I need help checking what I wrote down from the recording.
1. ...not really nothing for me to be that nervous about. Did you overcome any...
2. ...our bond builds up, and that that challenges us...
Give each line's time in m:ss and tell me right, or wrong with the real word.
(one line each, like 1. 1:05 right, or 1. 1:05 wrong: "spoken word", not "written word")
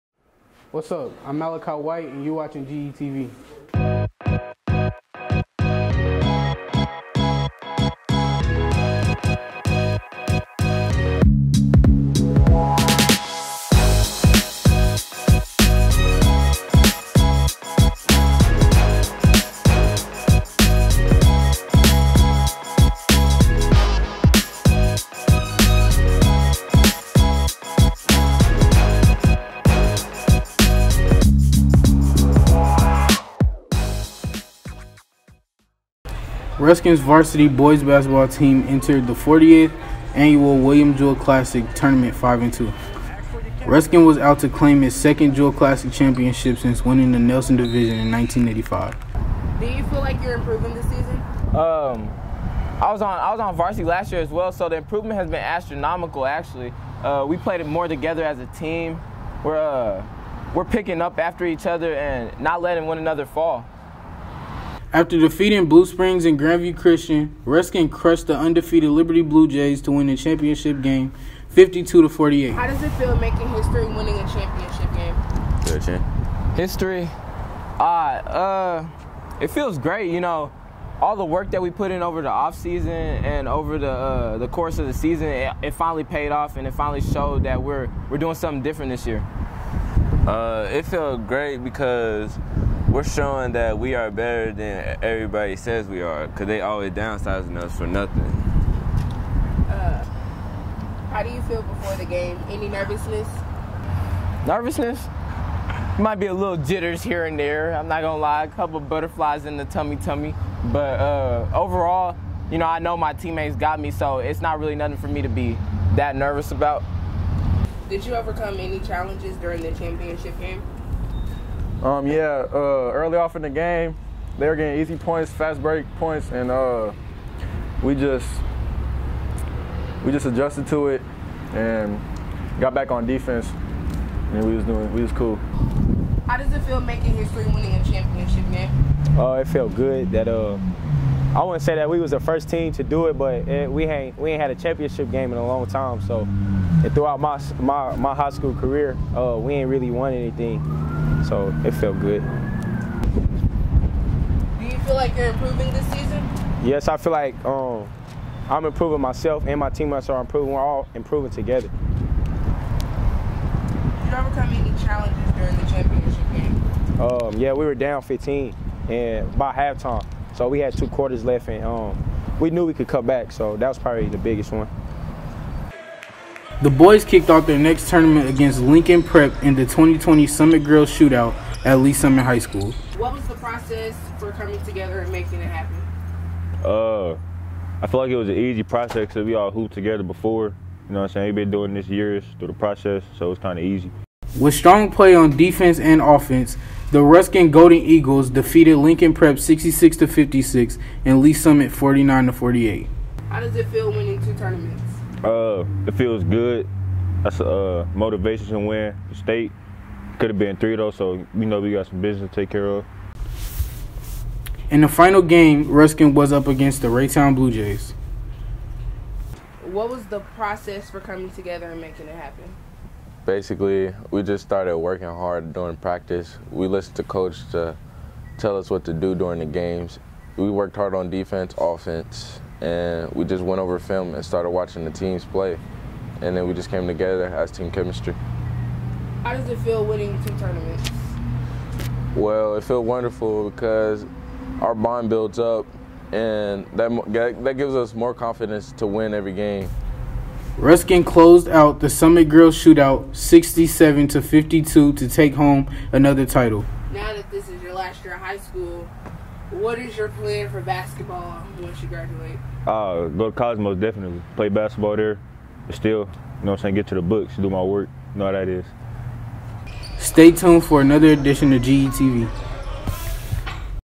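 1. 1:54 right
2. 4:04 wrong: "gives", not "challenges".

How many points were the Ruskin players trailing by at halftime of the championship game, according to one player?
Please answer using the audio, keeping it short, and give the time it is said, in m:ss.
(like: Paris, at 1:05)
15, at 2:48.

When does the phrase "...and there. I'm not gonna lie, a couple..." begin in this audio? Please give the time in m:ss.
1:47.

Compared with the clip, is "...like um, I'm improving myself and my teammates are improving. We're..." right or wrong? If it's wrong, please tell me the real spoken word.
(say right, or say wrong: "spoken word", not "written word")
right.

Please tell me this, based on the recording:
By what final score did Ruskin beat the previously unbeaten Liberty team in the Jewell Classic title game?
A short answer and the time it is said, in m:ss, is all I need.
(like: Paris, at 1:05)
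52 to 48, at 1:11.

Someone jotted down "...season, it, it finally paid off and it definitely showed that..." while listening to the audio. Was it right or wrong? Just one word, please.
wrong.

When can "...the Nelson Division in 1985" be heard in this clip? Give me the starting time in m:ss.
0:47.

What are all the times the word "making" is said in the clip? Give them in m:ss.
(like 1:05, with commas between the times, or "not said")
1:13, 2:16, 3:05, 3:41.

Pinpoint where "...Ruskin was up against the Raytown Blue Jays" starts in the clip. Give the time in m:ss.
3:35.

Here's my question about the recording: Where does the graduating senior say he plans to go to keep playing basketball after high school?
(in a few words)
Cosmos.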